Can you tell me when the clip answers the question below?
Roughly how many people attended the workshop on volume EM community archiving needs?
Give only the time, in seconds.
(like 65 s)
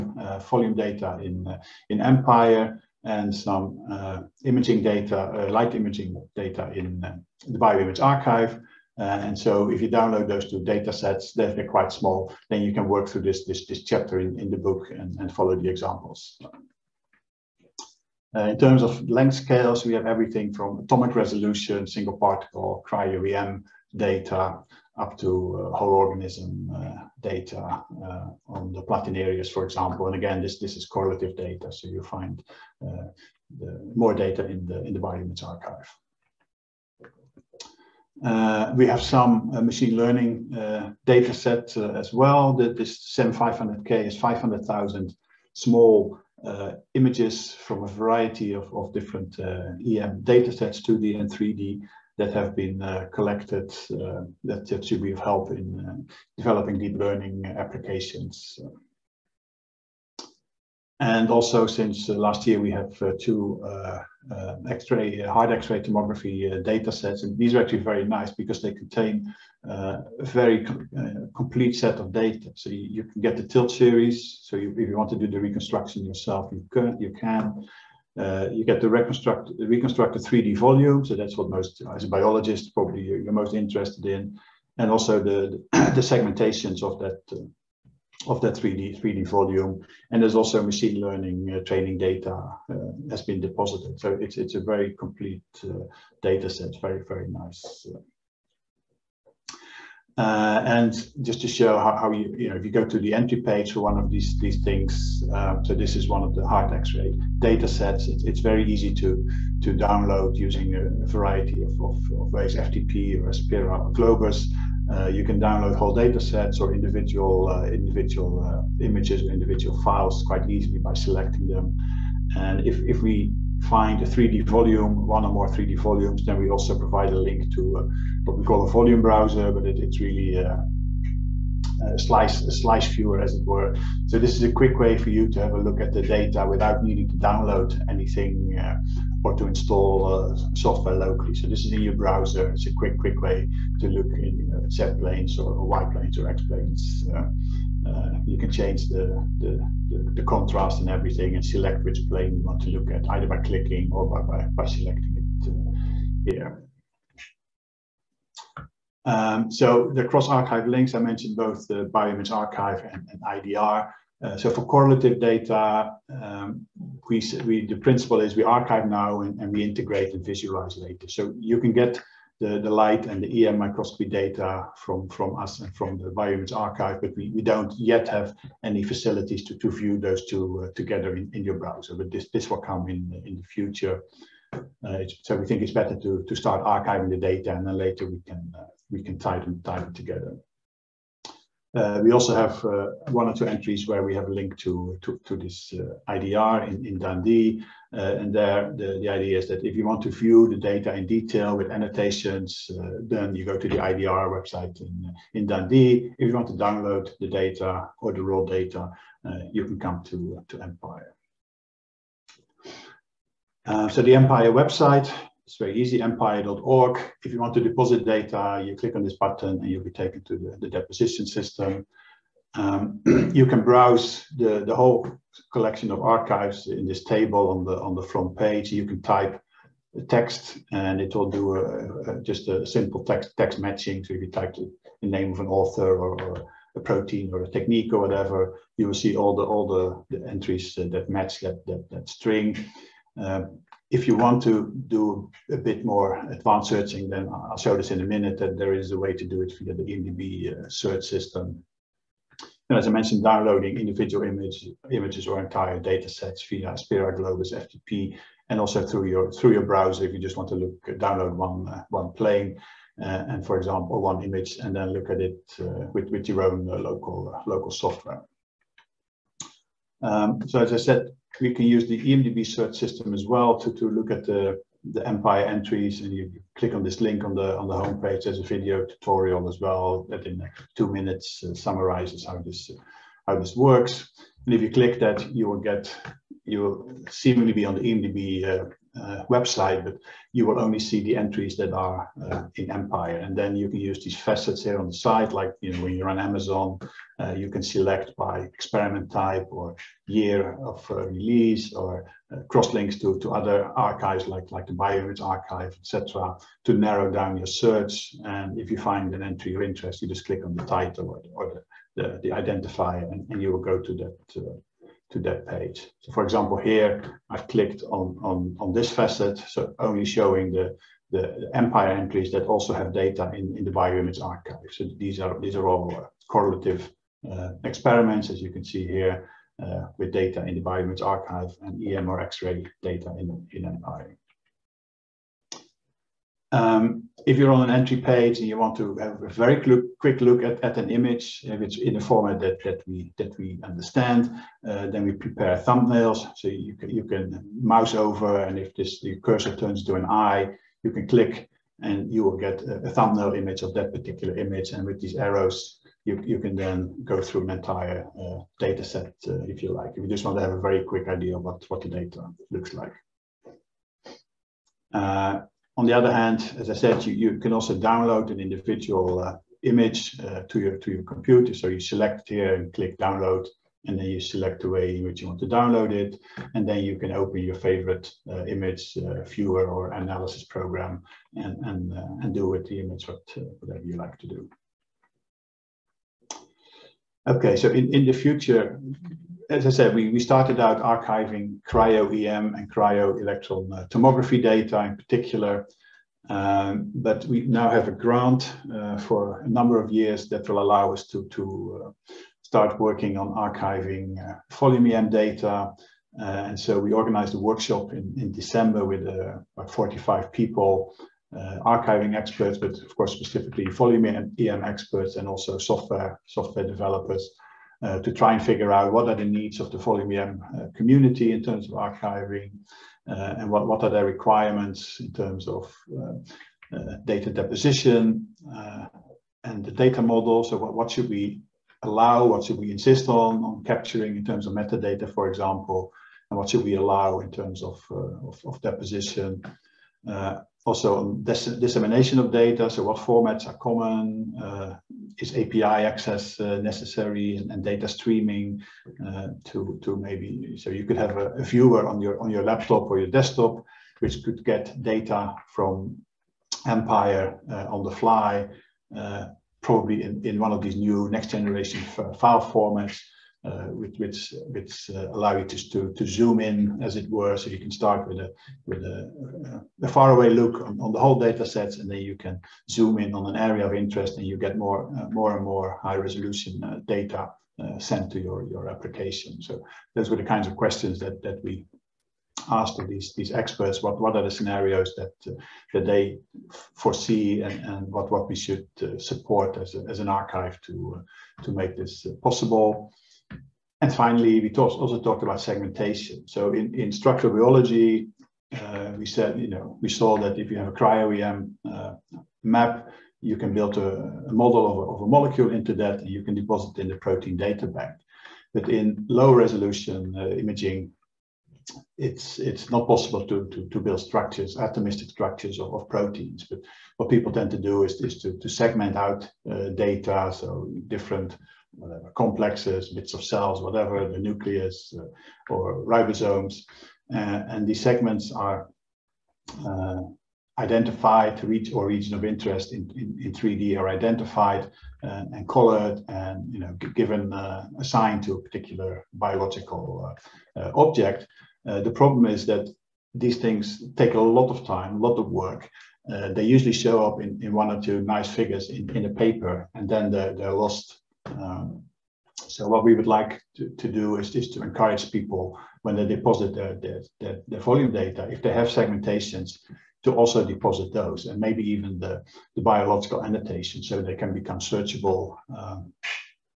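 409 s.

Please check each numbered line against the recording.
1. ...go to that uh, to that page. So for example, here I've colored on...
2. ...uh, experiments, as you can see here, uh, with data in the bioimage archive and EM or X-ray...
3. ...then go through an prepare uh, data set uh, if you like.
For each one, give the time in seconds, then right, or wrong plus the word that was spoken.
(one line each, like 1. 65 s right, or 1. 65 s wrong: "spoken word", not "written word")
1. 313 s wrong: "clicked", not "colored"
2. 327 s right
3. 356 s wrong: "entire", not "prepare".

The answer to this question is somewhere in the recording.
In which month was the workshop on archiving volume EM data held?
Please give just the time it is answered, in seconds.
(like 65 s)
408 s.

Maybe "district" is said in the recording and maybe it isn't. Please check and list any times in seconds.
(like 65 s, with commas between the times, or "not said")
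not said.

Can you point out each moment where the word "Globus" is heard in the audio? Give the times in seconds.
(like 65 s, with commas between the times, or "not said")
113 s, 257 s.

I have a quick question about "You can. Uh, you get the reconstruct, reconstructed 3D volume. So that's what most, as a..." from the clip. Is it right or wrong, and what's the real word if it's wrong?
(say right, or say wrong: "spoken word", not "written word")
right.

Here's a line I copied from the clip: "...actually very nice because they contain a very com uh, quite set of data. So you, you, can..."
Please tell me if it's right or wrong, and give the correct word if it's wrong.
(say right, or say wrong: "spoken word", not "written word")
wrong: "complete", not "quite".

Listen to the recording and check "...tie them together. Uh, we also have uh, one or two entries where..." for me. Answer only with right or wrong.
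right.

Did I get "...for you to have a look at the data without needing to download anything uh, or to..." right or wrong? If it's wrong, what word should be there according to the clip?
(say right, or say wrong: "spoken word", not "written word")
right.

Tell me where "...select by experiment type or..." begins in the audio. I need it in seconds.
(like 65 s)
297 s.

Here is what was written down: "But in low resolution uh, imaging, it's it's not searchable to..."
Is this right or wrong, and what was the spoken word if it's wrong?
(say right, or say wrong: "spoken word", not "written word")
wrong: "possible", not "searchable".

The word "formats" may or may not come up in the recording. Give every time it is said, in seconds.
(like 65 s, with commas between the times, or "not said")
342 s, 442 s, 462 s.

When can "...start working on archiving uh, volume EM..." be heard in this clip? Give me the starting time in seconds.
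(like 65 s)
402 s.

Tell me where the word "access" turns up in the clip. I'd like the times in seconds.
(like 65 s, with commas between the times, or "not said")
445 s.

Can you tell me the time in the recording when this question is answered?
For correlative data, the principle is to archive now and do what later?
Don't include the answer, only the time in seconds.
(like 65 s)
169 s.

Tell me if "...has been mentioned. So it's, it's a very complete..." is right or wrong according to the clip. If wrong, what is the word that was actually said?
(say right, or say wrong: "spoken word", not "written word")
wrong: "deposited", not "mentioned".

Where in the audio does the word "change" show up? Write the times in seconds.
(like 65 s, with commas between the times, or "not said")
148 s.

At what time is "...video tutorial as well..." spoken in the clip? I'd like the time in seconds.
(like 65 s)
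278 s.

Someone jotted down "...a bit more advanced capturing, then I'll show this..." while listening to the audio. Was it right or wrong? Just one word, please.
wrong.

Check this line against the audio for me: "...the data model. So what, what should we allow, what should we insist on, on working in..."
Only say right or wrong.
wrong.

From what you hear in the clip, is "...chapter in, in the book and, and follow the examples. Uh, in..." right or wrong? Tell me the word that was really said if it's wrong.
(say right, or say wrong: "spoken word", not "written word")
right.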